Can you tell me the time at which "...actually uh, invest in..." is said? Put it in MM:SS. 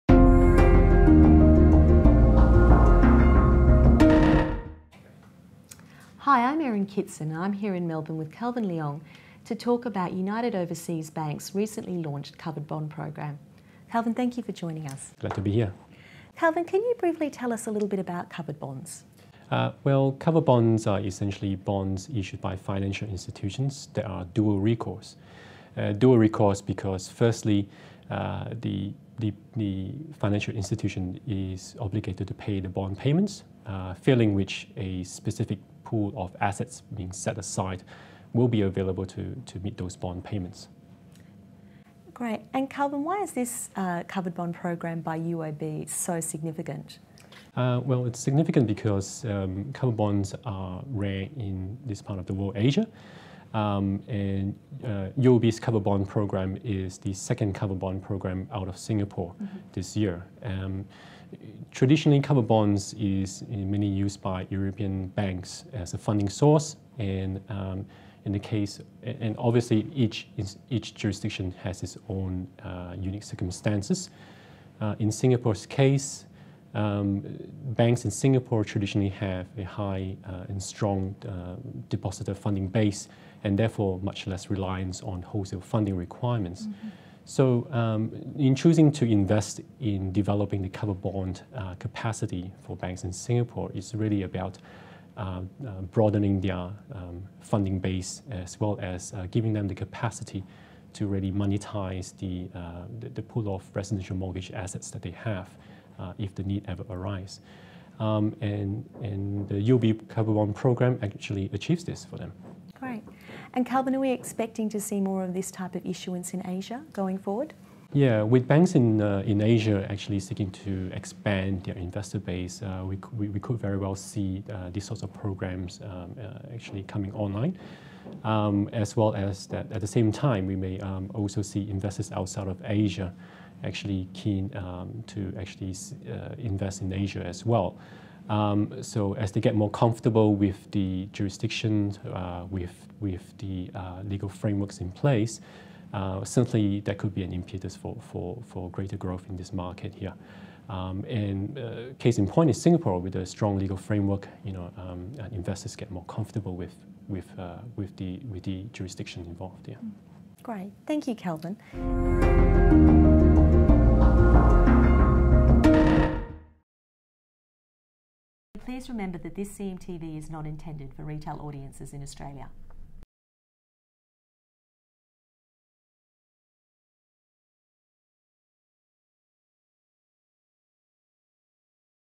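02:15.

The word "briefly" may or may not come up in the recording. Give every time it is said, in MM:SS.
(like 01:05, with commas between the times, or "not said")
00:16.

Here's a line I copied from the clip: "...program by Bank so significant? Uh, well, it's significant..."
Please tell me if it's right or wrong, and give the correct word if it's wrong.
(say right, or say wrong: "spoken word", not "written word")
wrong: "UOB", not "Bank".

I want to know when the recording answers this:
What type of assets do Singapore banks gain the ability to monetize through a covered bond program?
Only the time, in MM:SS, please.
01:43.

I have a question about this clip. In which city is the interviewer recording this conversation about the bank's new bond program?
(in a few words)
Melbourne.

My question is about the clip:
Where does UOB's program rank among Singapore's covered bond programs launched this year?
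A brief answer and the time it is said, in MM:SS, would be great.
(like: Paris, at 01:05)
Second, at 00:57.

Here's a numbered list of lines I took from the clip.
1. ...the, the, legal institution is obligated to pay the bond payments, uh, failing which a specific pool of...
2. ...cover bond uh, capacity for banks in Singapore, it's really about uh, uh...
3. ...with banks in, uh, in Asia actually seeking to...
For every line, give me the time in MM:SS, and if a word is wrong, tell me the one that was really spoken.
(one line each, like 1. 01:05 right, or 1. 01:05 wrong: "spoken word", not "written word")
1. 00:29 wrong: "financial", not "legal"
2. 01:30 right
3. 01:58 right.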